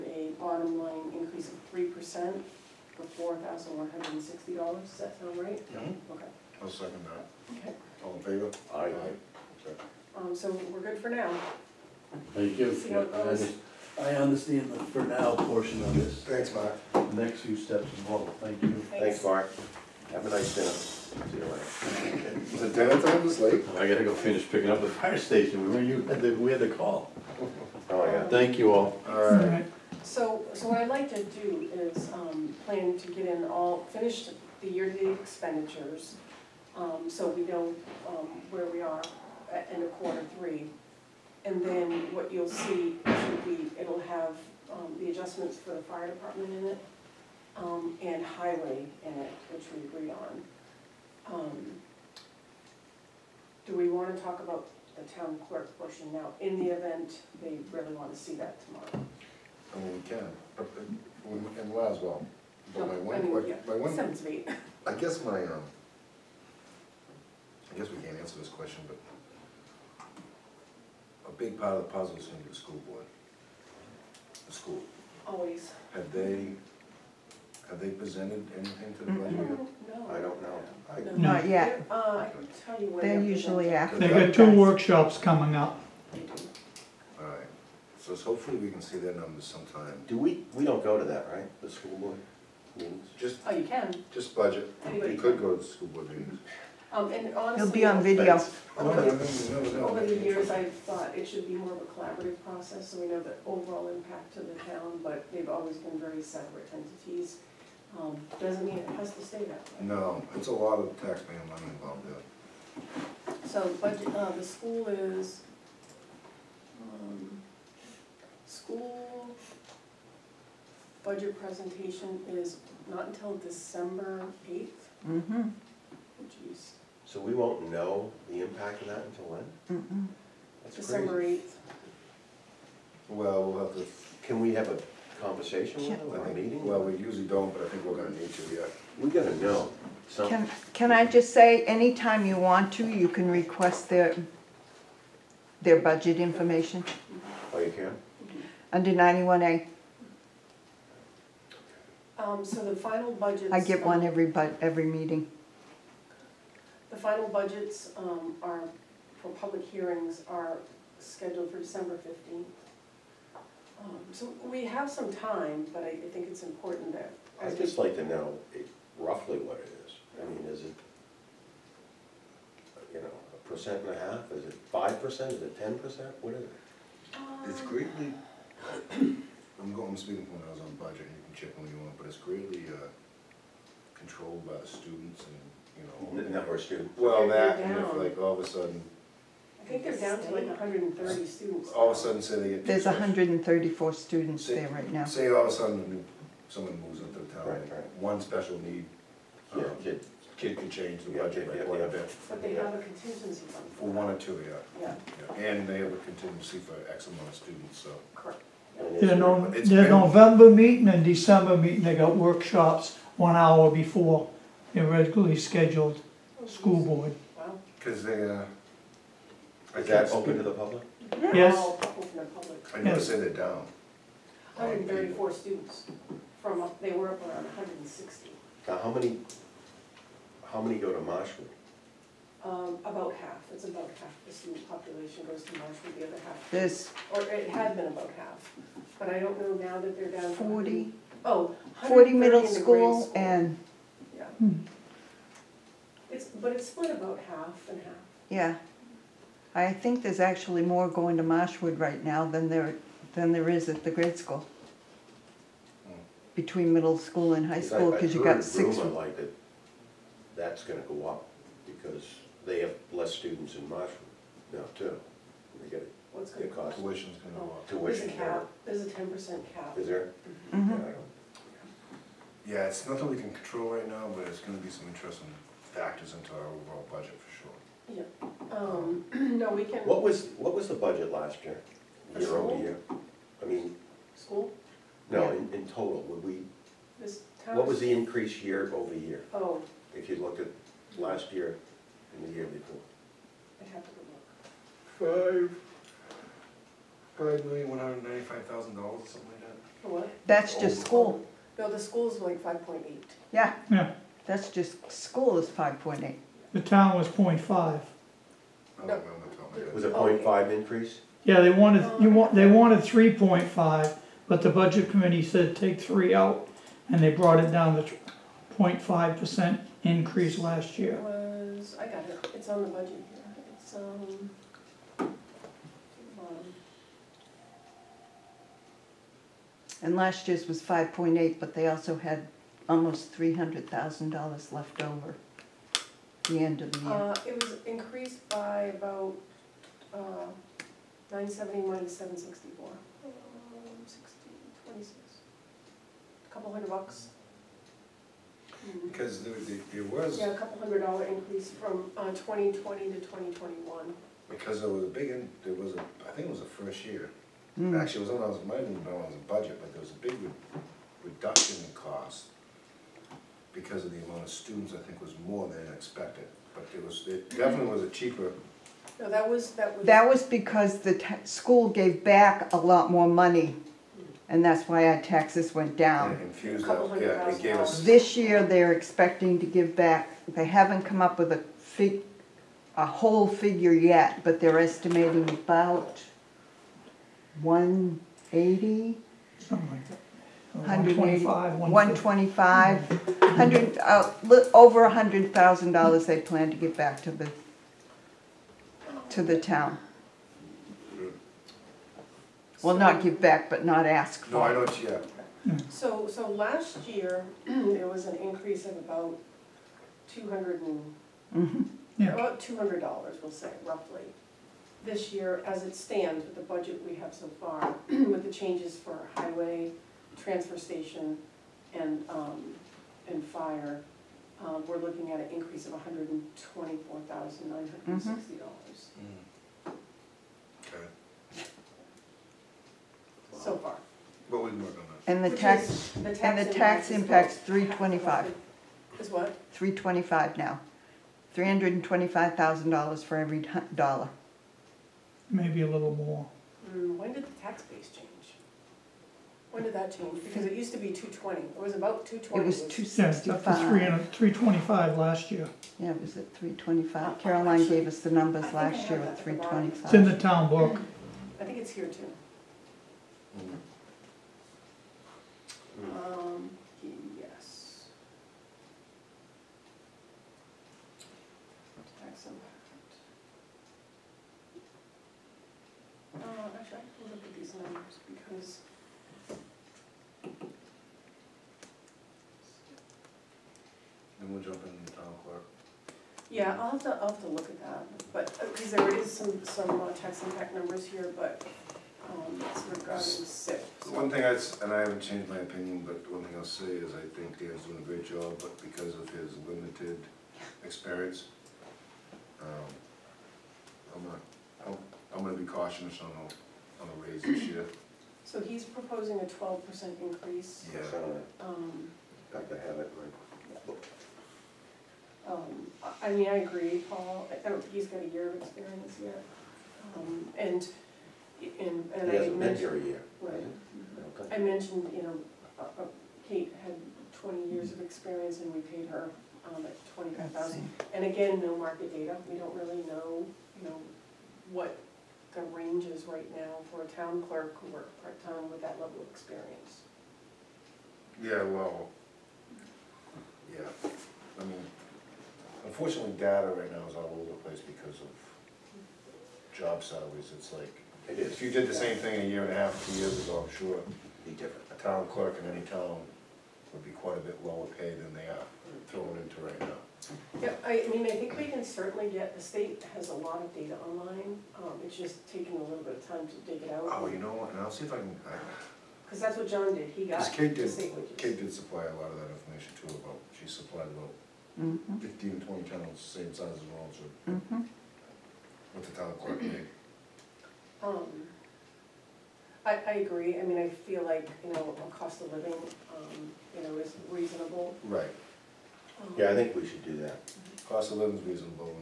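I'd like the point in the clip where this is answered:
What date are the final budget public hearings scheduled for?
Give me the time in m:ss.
2:41.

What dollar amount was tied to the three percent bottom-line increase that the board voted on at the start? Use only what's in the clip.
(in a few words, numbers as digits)
$4,160.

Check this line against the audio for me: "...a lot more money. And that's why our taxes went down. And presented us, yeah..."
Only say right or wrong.
wrong.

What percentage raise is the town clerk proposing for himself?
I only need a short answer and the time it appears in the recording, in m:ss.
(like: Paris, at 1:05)
12%, at 8:29.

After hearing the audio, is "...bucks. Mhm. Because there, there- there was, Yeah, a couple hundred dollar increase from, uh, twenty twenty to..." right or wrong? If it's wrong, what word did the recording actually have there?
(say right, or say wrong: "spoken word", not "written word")
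right.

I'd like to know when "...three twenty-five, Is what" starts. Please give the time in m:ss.
7:17.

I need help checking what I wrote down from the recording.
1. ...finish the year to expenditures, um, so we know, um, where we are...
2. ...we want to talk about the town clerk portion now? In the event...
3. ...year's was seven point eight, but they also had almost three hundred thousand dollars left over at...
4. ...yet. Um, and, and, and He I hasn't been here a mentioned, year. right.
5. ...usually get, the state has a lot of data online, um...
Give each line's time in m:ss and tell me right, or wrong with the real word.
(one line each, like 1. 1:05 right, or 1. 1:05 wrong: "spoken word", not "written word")
1. 0:33 right
2. 0:53 right
3. 5:30 wrong: "five", not "seven"
4. 8:39 right
5. 9:21 wrong: "certainly", not "usually".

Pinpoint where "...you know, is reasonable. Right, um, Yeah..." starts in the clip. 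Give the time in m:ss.
9:46.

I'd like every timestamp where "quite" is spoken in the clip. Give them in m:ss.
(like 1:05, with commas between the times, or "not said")
3:21, 9:16.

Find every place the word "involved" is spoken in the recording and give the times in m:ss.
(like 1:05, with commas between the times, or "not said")
0:17, 1:51.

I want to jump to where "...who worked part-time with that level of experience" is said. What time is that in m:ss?
8:57.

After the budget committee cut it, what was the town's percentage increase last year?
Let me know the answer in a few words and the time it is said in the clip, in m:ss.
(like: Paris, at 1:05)
0.5%, at 5:18.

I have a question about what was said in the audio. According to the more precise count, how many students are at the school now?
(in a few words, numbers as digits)
134.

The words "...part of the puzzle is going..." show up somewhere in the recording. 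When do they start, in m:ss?
1:11.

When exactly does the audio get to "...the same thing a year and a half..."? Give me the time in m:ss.
9:11.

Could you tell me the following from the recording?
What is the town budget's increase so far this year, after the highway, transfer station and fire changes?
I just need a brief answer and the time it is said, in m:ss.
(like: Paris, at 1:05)
$124,960, at 7:05.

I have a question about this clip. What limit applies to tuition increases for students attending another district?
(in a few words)
10% cap.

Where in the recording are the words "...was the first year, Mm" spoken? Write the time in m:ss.
5:56.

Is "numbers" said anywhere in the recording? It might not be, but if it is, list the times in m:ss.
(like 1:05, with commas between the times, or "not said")
1:29, 3:06, 7:38, 8:10.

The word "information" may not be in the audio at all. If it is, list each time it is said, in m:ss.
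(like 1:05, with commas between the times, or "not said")
2:26, 9:32.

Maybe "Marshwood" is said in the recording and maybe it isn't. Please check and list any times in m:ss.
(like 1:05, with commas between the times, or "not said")
3:50, 3:55, 4:11, 4:23.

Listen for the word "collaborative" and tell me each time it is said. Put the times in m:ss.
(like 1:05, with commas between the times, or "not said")
1:41.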